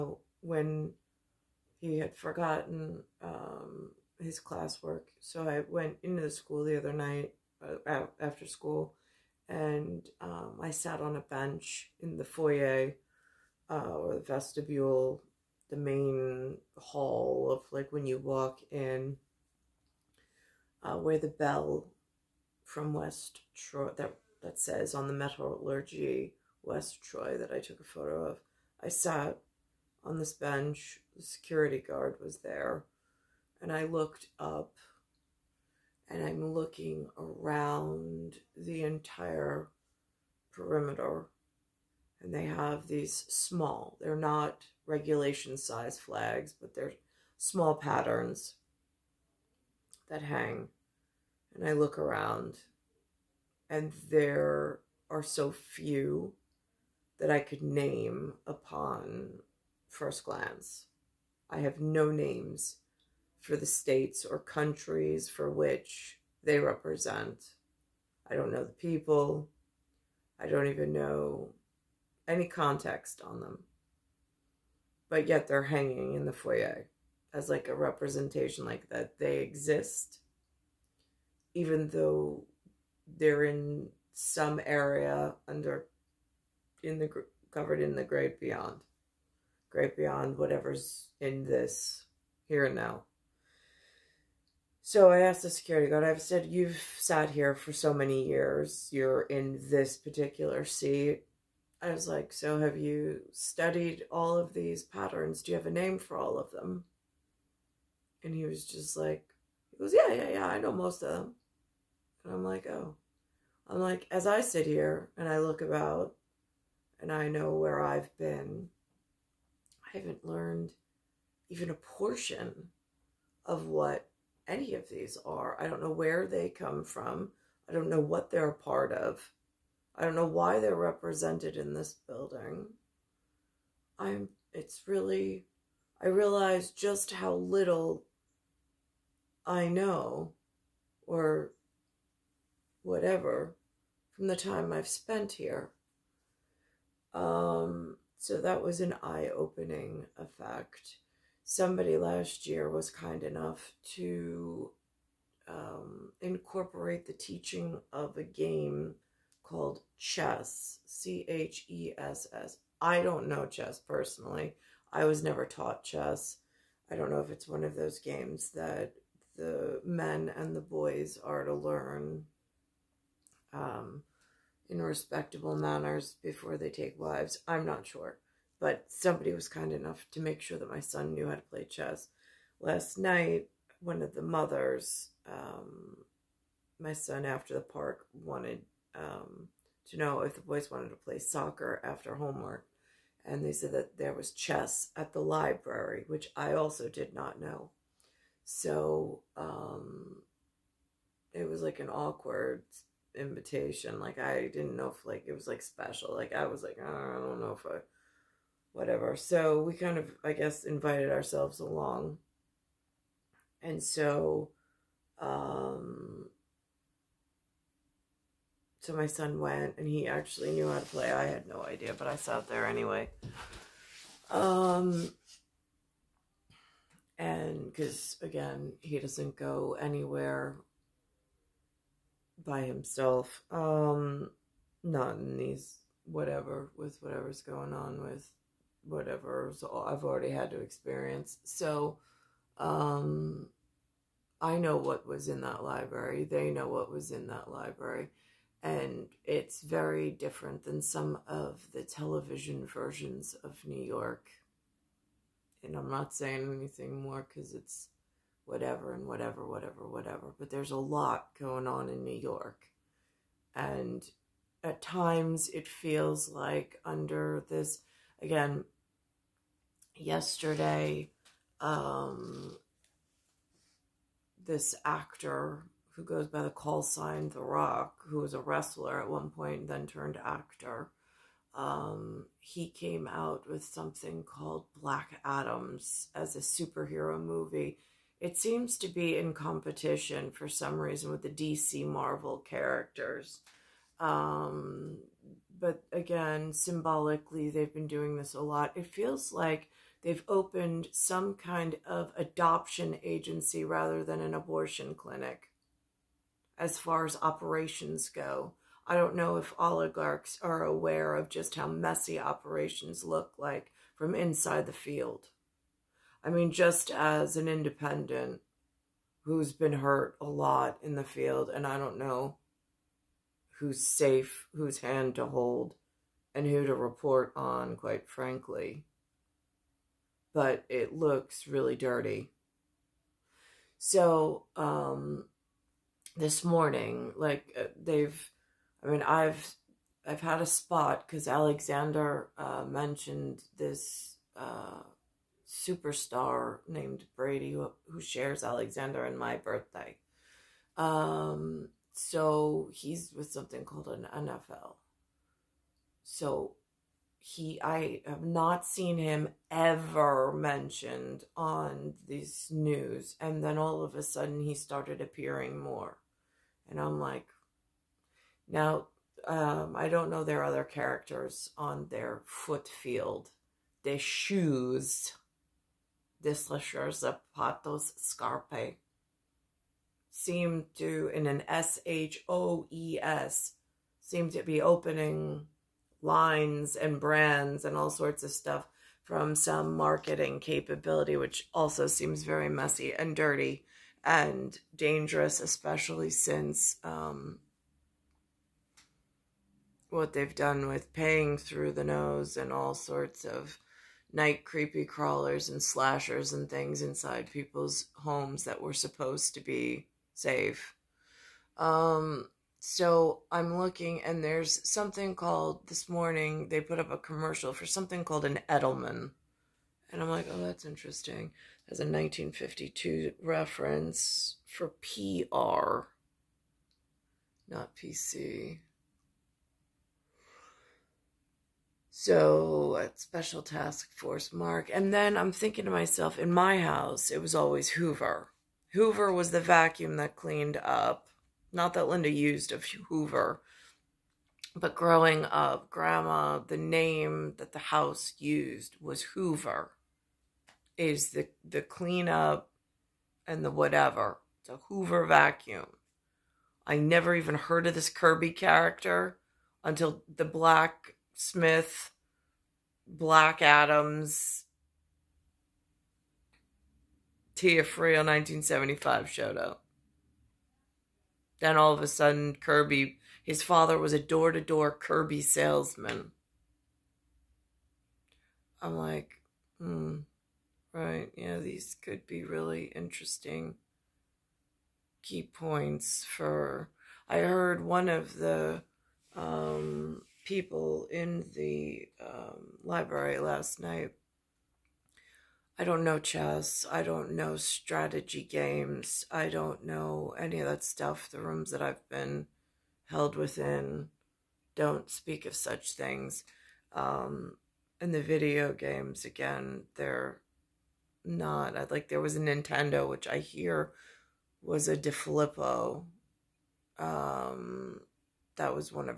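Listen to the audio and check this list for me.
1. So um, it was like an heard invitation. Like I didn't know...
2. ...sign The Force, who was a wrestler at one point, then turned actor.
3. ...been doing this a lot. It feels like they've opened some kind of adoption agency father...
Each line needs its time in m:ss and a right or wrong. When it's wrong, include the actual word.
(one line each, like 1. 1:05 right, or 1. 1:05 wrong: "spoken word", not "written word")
1. 3:18 wrong: "awkward", not "heard"
2. 4:36 wrong: "Rock", not "Force"
3. 4:57 wrong: "rather", not "father".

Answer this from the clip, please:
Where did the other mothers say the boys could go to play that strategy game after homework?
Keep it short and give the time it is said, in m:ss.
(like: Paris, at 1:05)
The library, at 3:15.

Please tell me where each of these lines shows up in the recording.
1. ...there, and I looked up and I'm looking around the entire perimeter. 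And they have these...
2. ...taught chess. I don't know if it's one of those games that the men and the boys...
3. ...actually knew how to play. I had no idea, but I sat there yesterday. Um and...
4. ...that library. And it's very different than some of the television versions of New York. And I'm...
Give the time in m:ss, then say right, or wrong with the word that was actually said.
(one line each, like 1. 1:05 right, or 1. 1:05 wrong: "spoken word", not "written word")
1. 0:32 right
2. 2:45 right
3. 3:40 wrong: "anyway", not "yesterday"
4. 4:07 right.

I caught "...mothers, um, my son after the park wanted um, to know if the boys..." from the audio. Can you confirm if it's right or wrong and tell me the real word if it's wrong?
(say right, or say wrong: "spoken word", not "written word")
right.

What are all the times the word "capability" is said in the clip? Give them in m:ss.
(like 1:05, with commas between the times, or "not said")
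6:30.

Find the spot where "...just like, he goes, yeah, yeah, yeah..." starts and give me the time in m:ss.
1:48.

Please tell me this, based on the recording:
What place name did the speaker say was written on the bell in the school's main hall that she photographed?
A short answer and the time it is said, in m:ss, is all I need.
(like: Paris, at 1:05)
West Troy, at 0:26.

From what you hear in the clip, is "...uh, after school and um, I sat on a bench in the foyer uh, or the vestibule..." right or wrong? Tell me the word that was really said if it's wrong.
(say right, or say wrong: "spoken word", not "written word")
right.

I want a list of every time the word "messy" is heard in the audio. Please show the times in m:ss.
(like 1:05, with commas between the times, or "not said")
5:11, 6:32.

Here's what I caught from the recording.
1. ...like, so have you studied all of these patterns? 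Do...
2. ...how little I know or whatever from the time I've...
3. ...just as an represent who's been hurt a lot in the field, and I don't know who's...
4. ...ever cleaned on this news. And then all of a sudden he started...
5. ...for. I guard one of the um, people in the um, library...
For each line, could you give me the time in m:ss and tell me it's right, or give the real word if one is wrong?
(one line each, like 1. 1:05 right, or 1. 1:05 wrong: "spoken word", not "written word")
1. 1:42 right
2. 2:17 right
3. 5:16 wrong: "independent", not "represent"
4. 5:59 wrong: "mentioned", not "cleaned"
5. 8:06 wrong: "heard", not "guard".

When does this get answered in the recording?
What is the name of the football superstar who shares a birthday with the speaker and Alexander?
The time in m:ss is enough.
5:47.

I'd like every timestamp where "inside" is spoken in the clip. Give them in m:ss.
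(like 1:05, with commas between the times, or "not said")
5:14, 6:46.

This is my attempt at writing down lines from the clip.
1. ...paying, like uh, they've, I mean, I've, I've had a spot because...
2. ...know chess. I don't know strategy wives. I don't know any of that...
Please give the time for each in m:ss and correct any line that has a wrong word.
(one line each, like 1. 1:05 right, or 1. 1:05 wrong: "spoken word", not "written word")
1. 5:36 wrong: "morning", not "paying"
2. 8:15 wrong: "games", not "wives".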